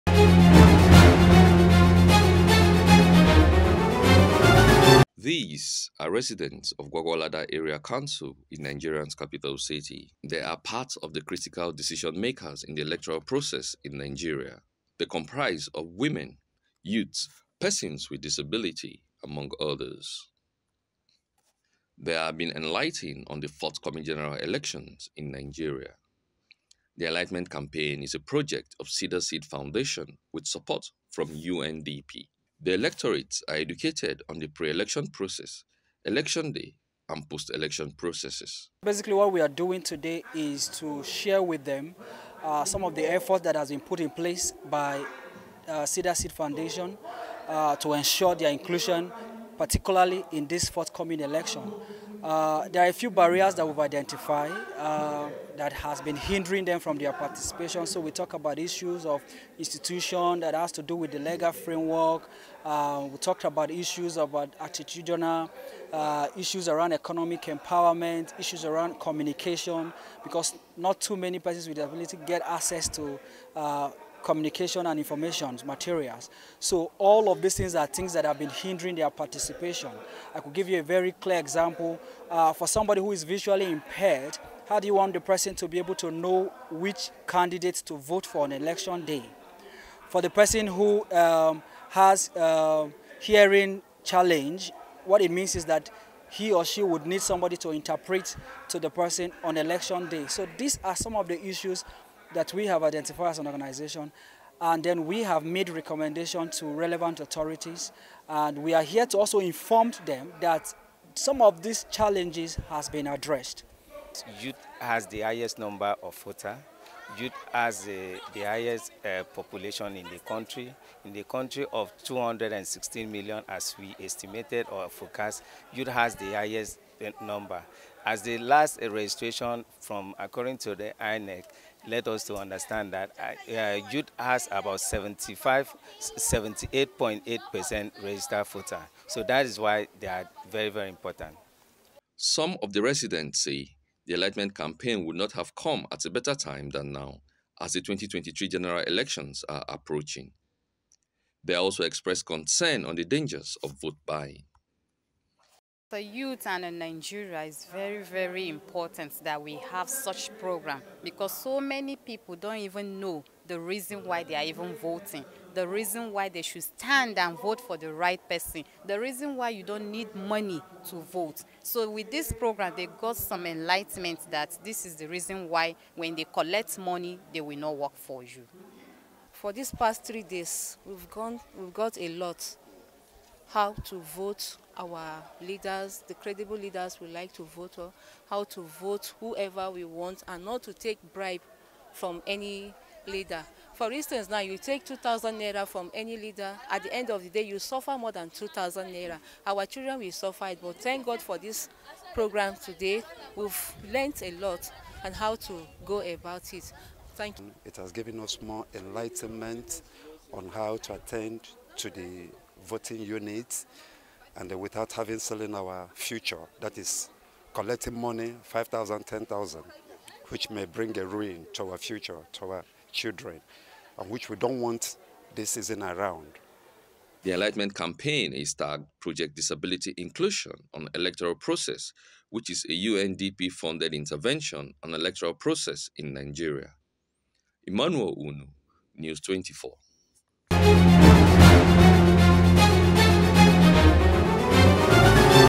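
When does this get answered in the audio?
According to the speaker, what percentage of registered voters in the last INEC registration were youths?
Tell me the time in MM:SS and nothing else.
02:15.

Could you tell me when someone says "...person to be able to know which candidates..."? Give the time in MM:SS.
01:25.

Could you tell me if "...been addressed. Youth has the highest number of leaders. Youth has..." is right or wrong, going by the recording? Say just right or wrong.
wrong.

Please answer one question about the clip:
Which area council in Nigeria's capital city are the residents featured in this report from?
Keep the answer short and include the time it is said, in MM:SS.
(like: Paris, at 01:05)
Gwagwalada, at 00:06.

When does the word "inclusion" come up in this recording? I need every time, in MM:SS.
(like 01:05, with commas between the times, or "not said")
00:48, 03:49.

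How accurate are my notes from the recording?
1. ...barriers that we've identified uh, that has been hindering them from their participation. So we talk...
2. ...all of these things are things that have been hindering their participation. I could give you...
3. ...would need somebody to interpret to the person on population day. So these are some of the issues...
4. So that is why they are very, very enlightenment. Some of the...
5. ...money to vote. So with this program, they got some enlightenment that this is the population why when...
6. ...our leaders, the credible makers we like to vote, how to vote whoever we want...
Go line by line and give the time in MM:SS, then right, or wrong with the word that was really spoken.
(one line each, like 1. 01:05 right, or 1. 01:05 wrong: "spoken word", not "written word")
1. 00:53 right
2. 01:16 right
3. 01:36 wrong: "election", not "population"
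4. 02:19 wrong: "important", not "enlightenment"
5. 02:50 wrong: "reason", not "population"
6. 03:04 wrong: "leaders", not "makers".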